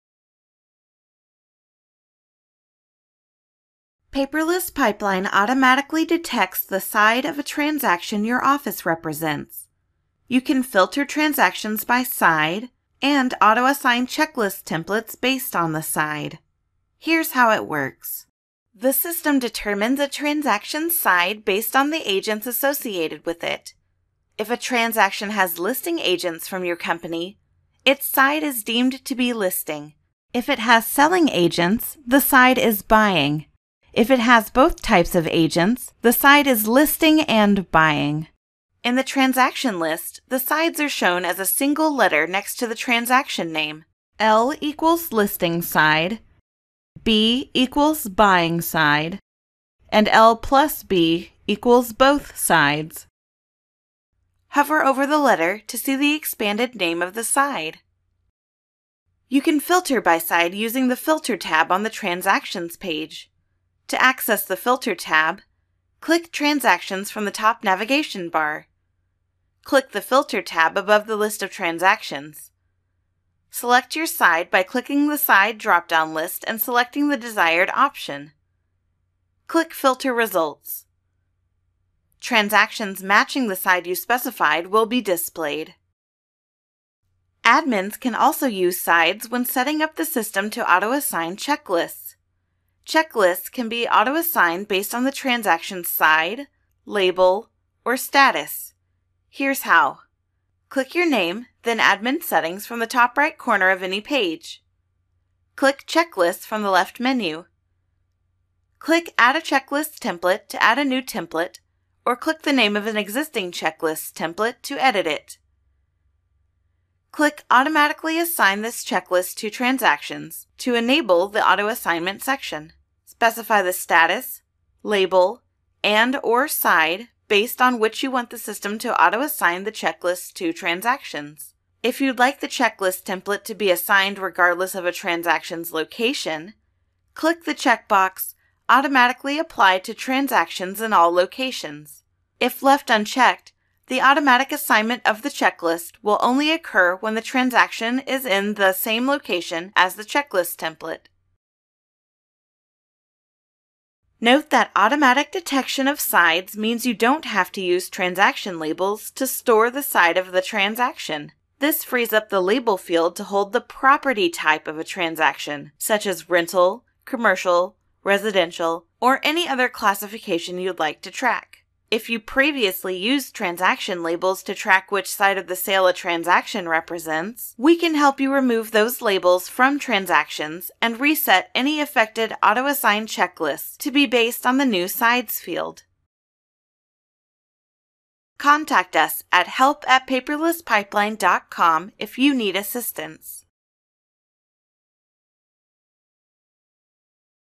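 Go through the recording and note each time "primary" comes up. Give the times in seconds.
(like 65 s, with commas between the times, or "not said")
not said.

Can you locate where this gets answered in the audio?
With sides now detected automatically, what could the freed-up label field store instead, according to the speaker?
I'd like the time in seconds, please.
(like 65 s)
163 s.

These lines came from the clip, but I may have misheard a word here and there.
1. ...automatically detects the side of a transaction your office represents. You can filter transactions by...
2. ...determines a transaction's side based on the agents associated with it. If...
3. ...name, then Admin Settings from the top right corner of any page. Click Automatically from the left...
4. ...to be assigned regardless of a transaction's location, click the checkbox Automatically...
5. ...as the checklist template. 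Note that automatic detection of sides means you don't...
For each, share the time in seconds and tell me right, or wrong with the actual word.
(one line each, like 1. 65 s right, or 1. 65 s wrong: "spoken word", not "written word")
1. 5 s right
2. 19 s right
3. 101 s wrong: "Checklists", not "Automatically"
4. 133 s right
5. 149 s right.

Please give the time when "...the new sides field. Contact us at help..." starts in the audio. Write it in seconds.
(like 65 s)
184 s.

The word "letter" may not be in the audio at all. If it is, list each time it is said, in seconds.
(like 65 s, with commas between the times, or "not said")
41 s, 55 s.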